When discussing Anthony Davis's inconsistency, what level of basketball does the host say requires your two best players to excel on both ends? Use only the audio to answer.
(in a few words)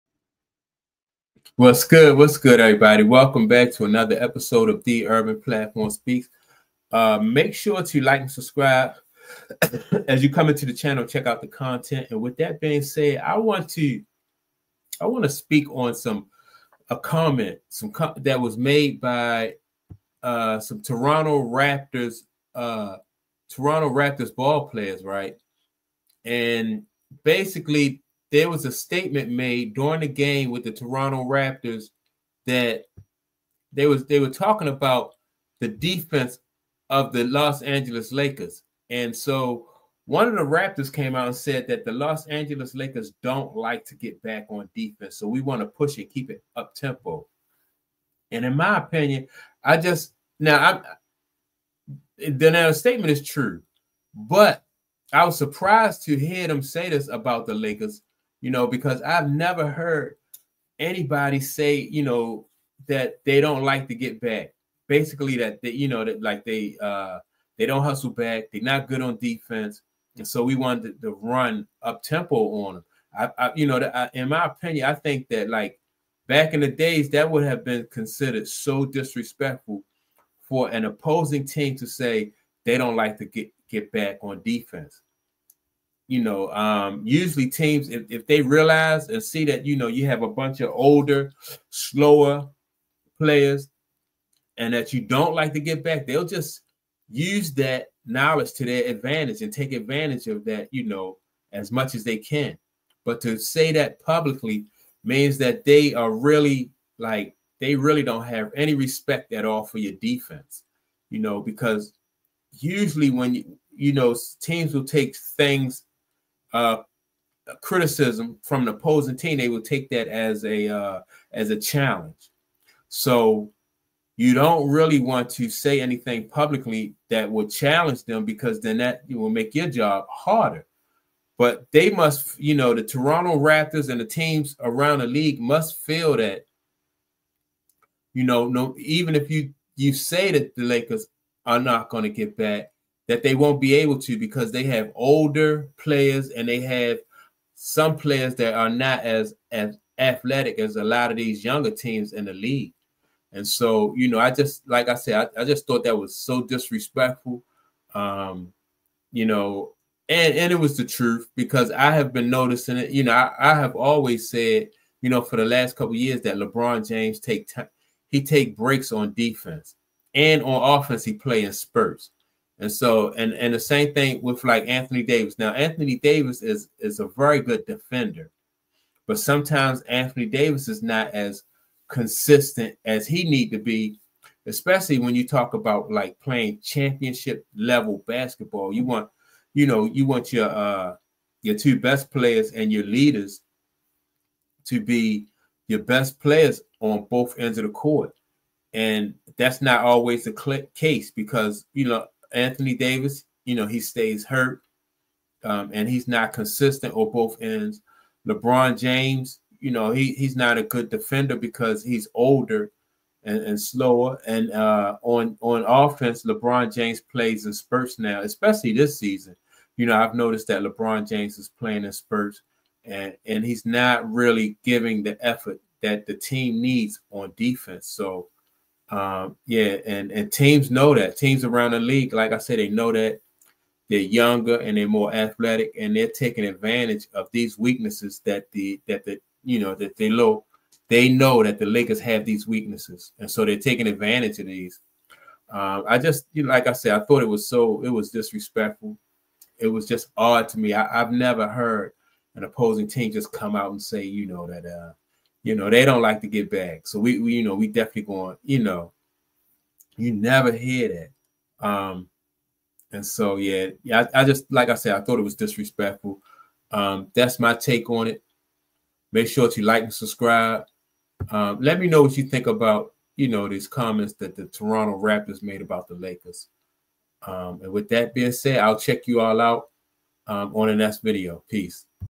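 Championship level.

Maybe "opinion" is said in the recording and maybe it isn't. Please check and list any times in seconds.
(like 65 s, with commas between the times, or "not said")
48 s, 74 s.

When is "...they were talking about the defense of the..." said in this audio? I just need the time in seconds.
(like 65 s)
34 s.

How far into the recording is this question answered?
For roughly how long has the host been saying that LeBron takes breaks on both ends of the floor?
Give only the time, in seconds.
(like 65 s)
165 s.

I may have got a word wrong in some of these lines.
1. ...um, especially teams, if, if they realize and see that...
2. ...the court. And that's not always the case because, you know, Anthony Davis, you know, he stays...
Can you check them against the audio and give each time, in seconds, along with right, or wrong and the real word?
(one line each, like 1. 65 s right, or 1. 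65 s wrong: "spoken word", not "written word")
1. 86 s wrong: "usually", not "especially"
2. 197 s right.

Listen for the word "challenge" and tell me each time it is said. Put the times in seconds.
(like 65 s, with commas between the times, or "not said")
121 s, 127 s.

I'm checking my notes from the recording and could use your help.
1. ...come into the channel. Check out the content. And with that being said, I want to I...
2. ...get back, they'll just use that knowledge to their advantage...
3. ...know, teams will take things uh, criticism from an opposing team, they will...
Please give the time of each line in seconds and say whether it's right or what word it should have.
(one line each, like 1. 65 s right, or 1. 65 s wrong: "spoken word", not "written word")
1. 10 s right
2. 95 s right
3. 113 s right.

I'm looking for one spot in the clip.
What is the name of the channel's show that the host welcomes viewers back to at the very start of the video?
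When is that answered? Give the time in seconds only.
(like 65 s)
4 s.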